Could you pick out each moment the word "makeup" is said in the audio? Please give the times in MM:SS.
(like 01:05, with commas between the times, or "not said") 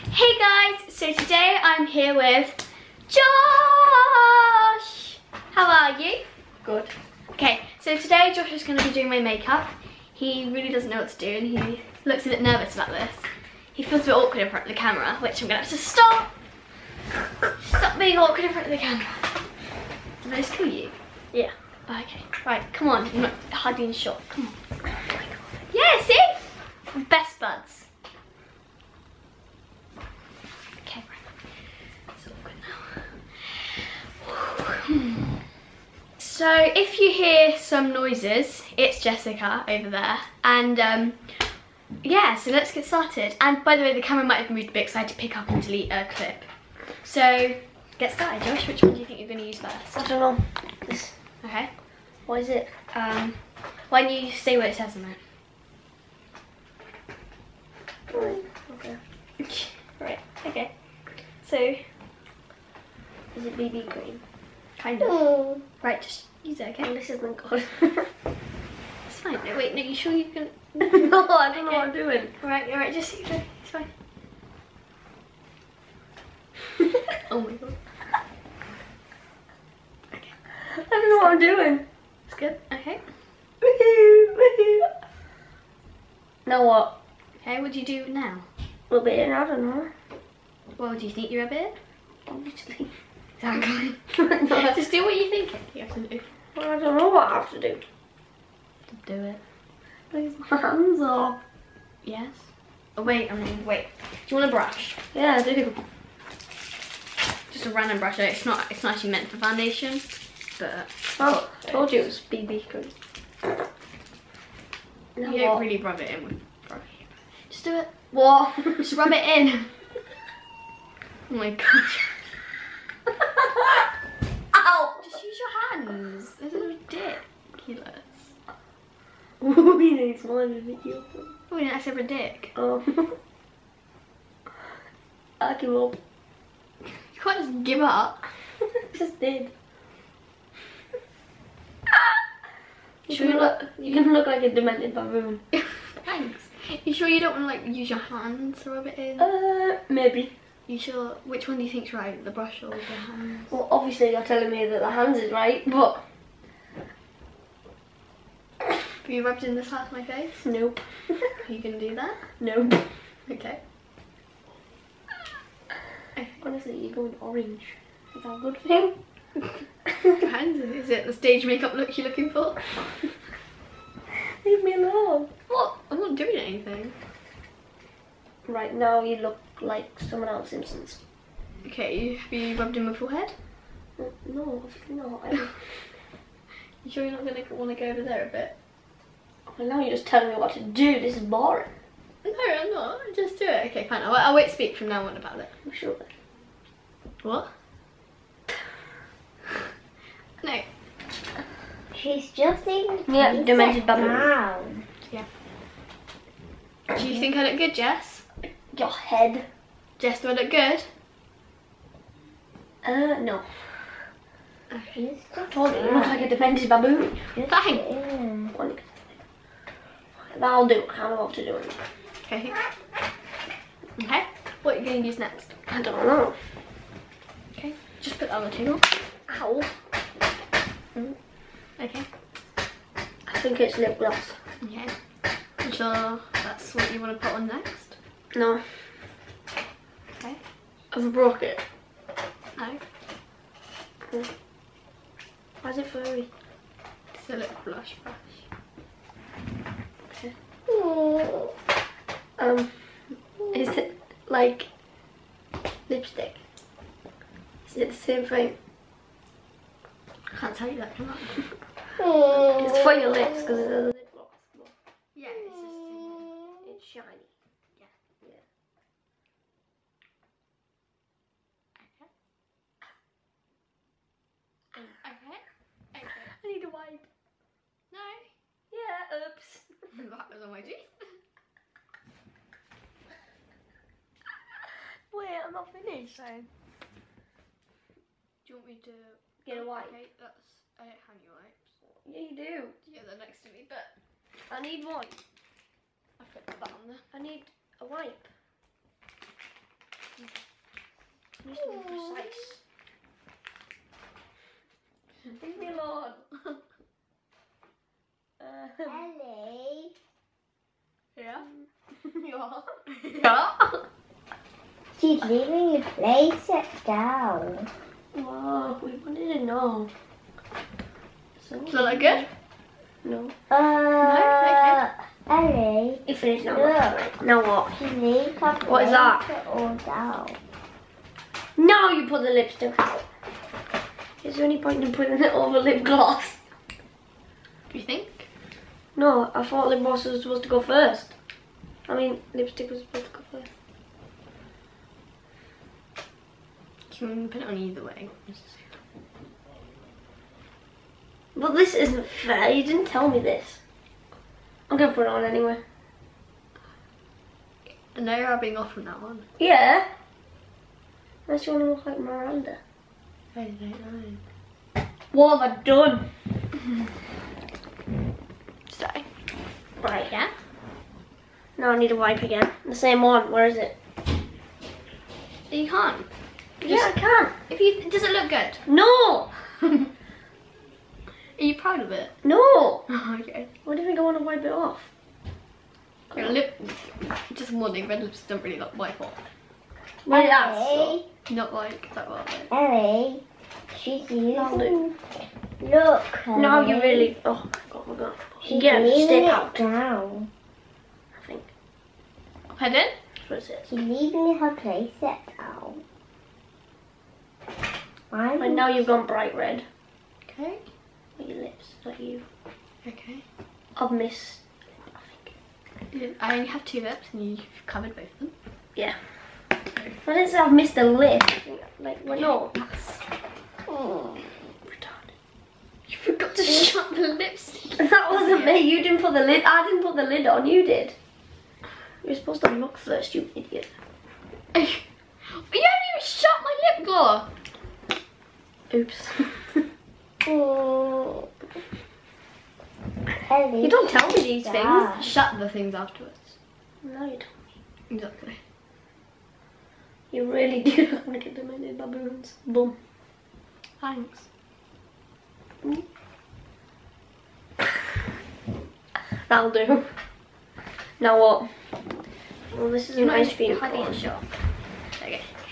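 00:09, 02:51.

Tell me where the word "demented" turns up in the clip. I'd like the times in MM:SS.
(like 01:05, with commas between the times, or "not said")
02:24, 03:23, 07:31.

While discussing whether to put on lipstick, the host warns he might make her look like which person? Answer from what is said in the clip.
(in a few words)
Miranda.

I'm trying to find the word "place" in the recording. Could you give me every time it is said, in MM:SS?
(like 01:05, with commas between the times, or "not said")
05:15, 06:44.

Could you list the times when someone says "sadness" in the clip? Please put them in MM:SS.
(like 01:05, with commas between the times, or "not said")
not said.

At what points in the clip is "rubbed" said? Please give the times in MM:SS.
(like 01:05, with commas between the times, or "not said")
02:39, 03:02.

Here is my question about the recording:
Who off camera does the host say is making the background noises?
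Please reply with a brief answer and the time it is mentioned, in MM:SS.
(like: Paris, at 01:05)
Jessica, at 00:39.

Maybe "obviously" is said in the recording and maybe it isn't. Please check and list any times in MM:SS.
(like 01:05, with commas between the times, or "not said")
01:32, 02:33, 03:04.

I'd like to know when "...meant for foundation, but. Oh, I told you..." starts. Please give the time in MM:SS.
01:49.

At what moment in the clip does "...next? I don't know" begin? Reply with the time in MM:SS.
03:45.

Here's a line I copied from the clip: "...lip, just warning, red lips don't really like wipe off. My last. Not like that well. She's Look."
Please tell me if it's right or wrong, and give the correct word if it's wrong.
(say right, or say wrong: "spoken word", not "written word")
right.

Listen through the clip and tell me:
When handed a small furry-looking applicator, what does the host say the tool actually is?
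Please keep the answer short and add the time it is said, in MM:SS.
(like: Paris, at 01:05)
blush brush, at 04:07.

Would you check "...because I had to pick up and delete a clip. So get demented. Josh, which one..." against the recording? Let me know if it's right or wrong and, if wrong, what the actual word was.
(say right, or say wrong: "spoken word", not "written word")
wrong: "started", not "demented".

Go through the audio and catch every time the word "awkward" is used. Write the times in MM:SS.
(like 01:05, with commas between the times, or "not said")
00:14, 00:18.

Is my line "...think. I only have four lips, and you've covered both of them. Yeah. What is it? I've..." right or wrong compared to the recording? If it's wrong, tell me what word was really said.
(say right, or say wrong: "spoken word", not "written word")
wrong: "two", not "four".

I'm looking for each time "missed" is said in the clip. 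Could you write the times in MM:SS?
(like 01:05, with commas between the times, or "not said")
06:53, 07:00.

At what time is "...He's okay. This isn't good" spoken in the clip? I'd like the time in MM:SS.
01:06.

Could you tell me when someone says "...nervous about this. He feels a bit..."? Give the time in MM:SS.
00:12.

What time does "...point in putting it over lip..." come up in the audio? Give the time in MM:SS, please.
05:34.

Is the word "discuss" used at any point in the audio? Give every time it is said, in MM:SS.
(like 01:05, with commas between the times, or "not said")
not said.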